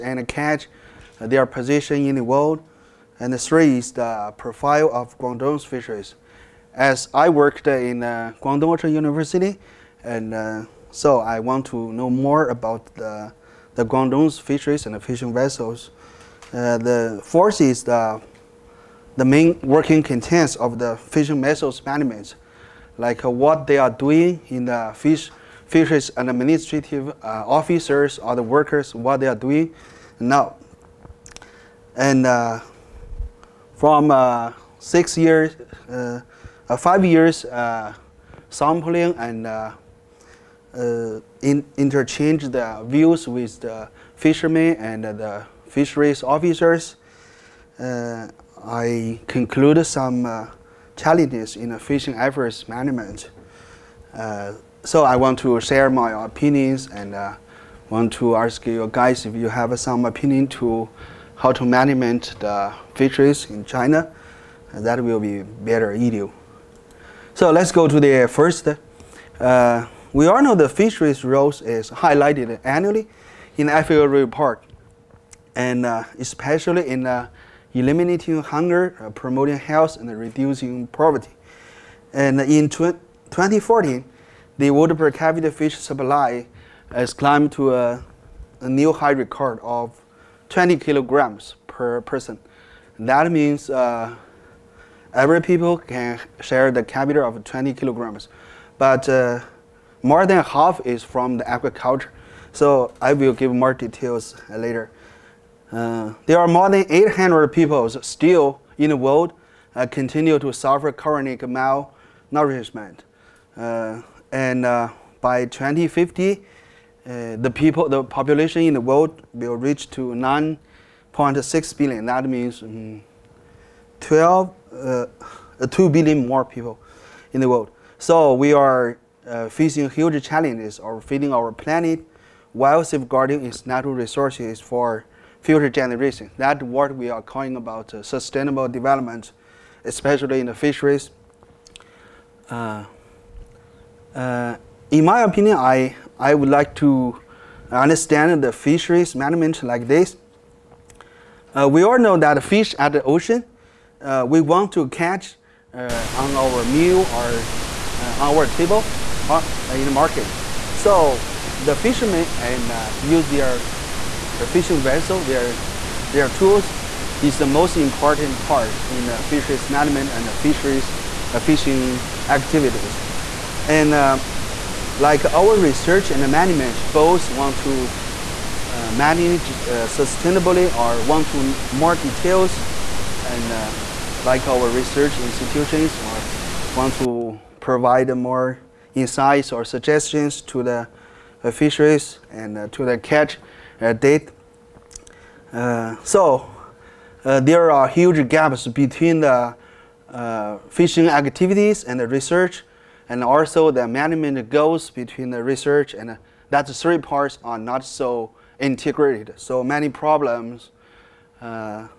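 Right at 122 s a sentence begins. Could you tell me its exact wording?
That means mm, 12, uh, 2 billion more people in the world.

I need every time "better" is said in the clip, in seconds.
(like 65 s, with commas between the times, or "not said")
65 s.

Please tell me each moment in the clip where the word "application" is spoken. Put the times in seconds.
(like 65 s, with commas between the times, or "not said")
not said.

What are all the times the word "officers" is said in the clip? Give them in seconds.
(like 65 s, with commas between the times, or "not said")
27 s, 46 s.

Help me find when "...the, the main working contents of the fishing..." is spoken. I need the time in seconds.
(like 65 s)
17 s.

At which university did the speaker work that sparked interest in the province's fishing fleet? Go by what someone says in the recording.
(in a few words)
Guangdong Ocean University.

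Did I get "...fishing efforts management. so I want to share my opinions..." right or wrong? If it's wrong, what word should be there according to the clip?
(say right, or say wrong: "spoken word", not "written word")
right.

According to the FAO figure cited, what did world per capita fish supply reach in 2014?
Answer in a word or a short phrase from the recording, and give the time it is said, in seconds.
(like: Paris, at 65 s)
20 kilograms, at 90 s.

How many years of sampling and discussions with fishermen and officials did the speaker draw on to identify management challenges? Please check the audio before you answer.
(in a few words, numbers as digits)
5.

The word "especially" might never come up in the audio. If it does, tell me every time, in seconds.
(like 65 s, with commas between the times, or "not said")
76 s, 139 s.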